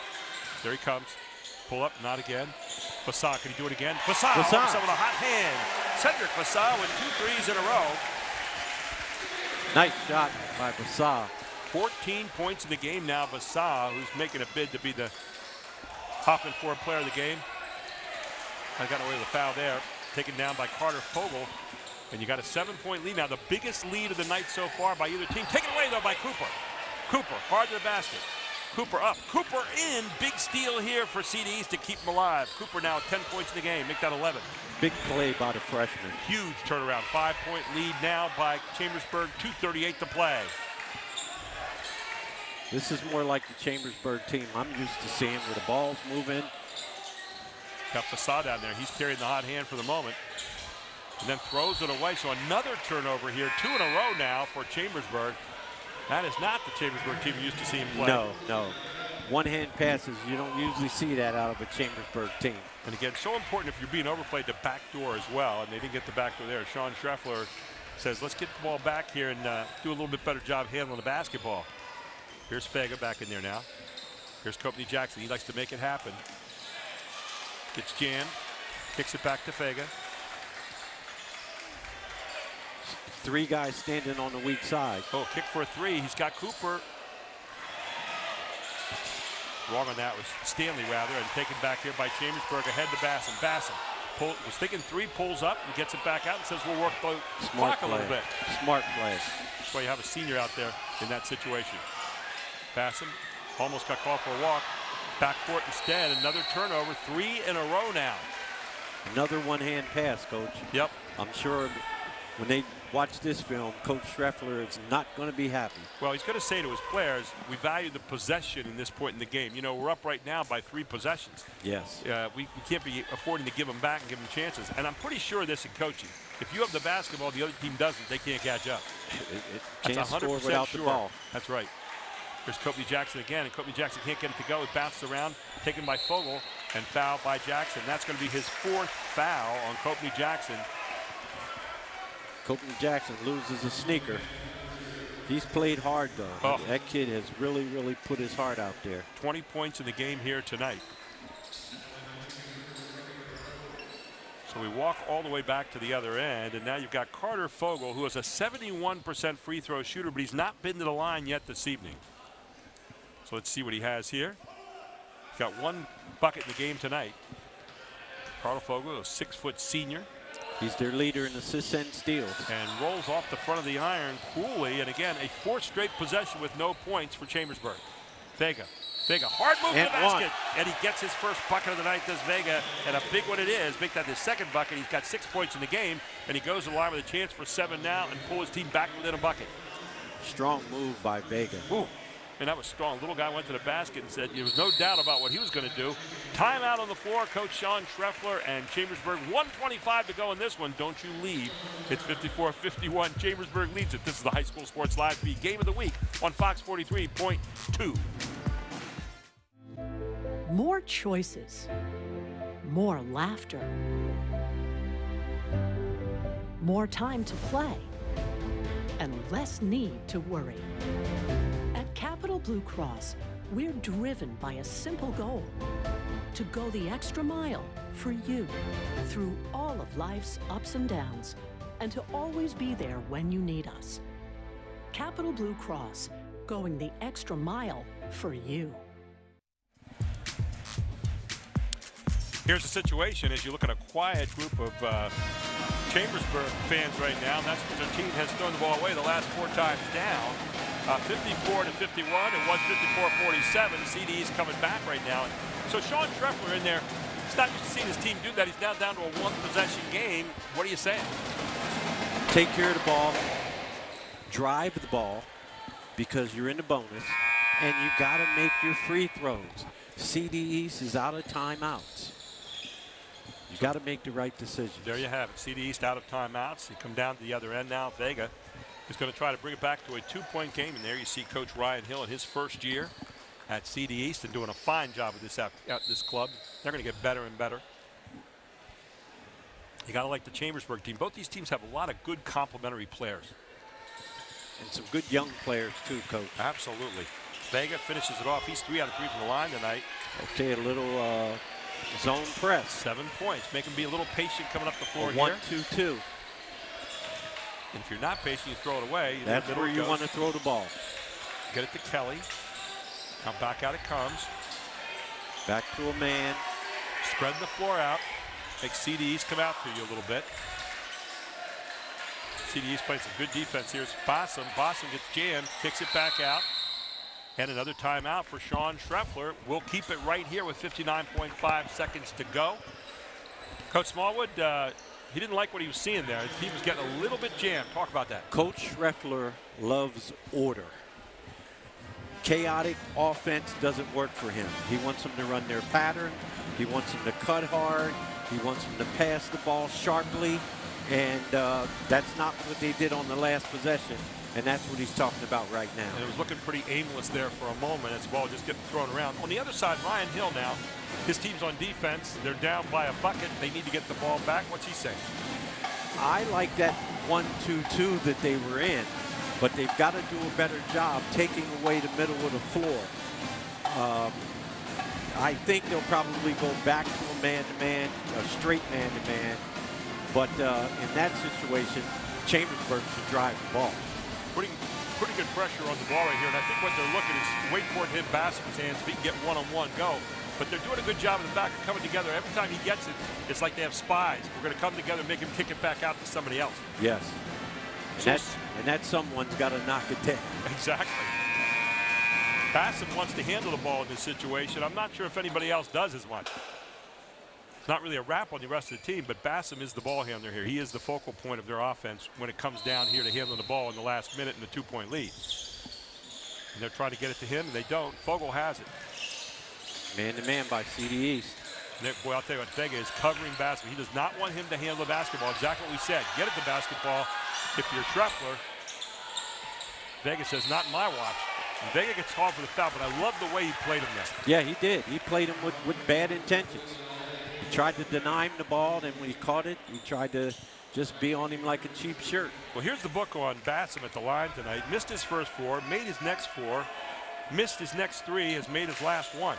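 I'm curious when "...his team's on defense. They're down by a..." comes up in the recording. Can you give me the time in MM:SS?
06:01.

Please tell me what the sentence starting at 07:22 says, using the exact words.
Well, here's the book on Bassam at the line tonight.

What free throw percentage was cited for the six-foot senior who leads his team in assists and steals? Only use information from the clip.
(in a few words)
71%.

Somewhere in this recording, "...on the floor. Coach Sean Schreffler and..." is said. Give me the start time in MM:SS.
03:16.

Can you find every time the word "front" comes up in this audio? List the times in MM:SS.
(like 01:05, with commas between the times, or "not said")
02:53.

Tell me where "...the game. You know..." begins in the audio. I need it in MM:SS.
01:59.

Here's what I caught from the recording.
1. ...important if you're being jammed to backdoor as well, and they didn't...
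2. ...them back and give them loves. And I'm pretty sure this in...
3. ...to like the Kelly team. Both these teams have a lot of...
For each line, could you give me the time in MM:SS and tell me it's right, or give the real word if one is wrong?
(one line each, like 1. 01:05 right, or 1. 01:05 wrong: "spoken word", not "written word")
1. 01:03 wrong: "overplayed", not "jammed"
2. 02:03 wrong: "chances", not "loves"
3. 04:50 wrong: "Chambersburg", not "Kelly".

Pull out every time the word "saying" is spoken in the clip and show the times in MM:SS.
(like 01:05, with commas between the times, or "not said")
04:20, 06:04.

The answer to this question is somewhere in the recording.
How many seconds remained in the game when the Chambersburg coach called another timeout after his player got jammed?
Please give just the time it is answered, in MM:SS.
05:30.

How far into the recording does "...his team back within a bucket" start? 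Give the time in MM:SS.
03:08.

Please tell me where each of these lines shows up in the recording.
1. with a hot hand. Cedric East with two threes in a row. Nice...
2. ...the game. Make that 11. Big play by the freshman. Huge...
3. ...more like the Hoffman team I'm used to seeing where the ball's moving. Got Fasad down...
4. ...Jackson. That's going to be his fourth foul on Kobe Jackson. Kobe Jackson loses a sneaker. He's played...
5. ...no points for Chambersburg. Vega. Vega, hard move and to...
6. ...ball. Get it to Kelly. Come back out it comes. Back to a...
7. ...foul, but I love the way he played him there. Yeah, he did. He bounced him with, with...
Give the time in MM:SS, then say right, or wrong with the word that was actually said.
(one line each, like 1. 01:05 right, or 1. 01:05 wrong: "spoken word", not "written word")
1. 00:04 wrong: "Fassad", not "East"
2. 00:33 right
3. 00:43 wrong: "Chambersburg", not "Hoffman"
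4. 02:17 right
5. 02:56 right
6. 05:10 right
7. 07:12 wrong: "played", not "bounced".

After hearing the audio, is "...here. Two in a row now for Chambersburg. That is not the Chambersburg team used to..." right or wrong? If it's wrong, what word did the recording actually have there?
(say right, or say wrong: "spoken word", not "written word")
right.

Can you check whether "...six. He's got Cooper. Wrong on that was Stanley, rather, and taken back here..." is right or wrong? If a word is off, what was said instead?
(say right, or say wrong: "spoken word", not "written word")
wrong: "three", not "six".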